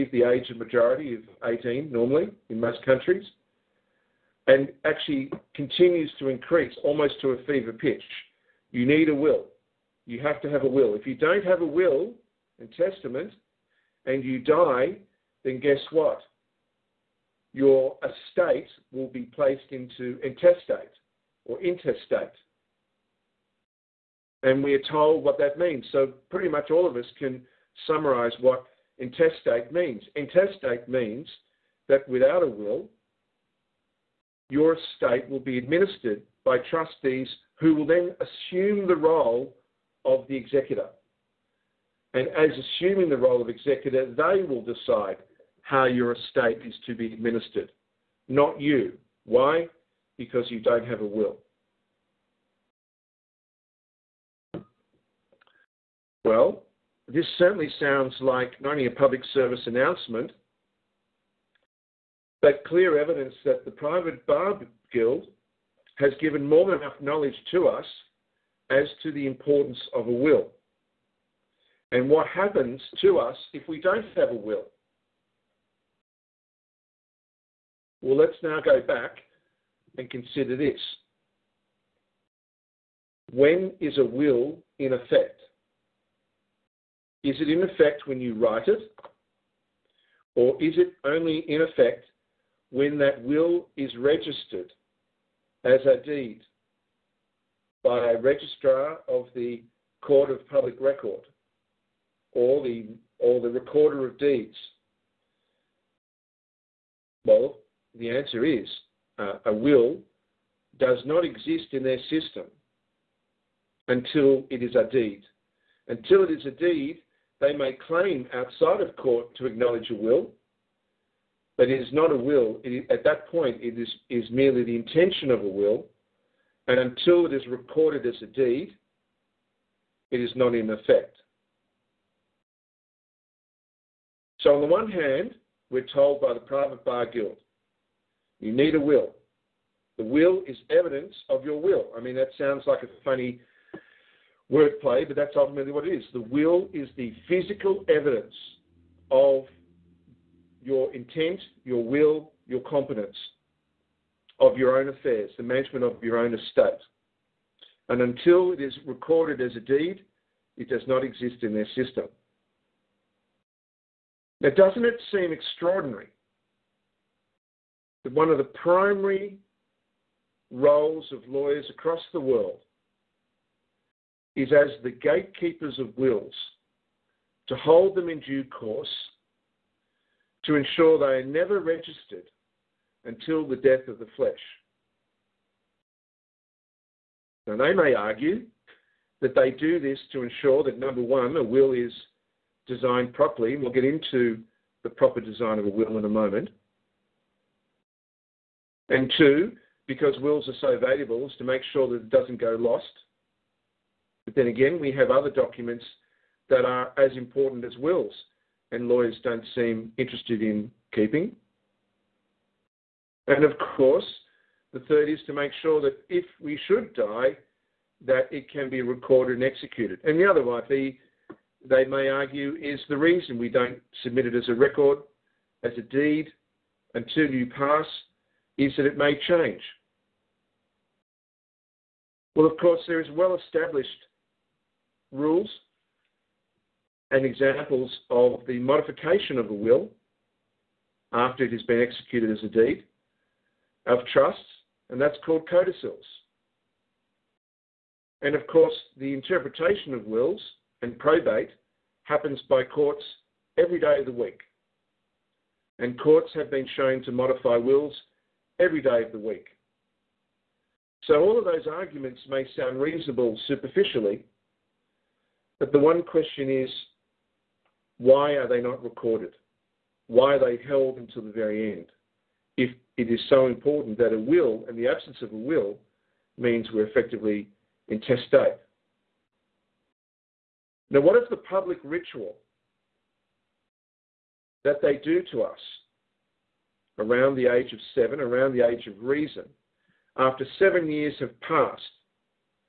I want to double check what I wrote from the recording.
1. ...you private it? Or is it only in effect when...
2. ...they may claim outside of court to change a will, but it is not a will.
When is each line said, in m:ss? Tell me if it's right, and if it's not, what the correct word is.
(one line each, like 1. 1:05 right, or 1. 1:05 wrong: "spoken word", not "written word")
1. 1:28 wrong: "write", not "private"
2. 1:57 wrong: "acknowledge", not "change".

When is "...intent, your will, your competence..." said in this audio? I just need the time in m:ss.
2:30.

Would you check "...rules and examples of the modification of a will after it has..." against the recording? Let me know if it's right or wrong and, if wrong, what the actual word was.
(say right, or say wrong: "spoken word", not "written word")
right.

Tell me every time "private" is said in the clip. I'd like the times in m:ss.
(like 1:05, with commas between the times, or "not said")
1:03, 2:16.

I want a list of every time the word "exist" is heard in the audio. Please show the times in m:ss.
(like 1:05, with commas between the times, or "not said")
1:51, 2:41.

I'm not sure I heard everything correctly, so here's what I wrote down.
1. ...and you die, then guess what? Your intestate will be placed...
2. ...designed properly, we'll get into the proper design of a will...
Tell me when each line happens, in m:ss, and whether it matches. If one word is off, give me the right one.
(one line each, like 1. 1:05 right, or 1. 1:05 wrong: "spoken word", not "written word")
1. 0:14 wrong: "estate", not "intestate"
2. 3:12 right.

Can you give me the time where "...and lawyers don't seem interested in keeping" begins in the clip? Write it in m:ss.
3:28.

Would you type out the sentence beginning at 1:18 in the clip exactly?
Well, let's now go back and consider this.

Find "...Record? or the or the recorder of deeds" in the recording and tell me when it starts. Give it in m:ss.
1:40.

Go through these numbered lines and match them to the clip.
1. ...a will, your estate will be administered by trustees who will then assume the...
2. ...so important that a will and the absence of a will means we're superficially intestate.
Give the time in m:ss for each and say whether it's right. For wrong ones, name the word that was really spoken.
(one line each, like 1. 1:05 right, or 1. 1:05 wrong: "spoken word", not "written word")
1. 0:32 right
2. 4:33 wrong: "effectively", not "superficially".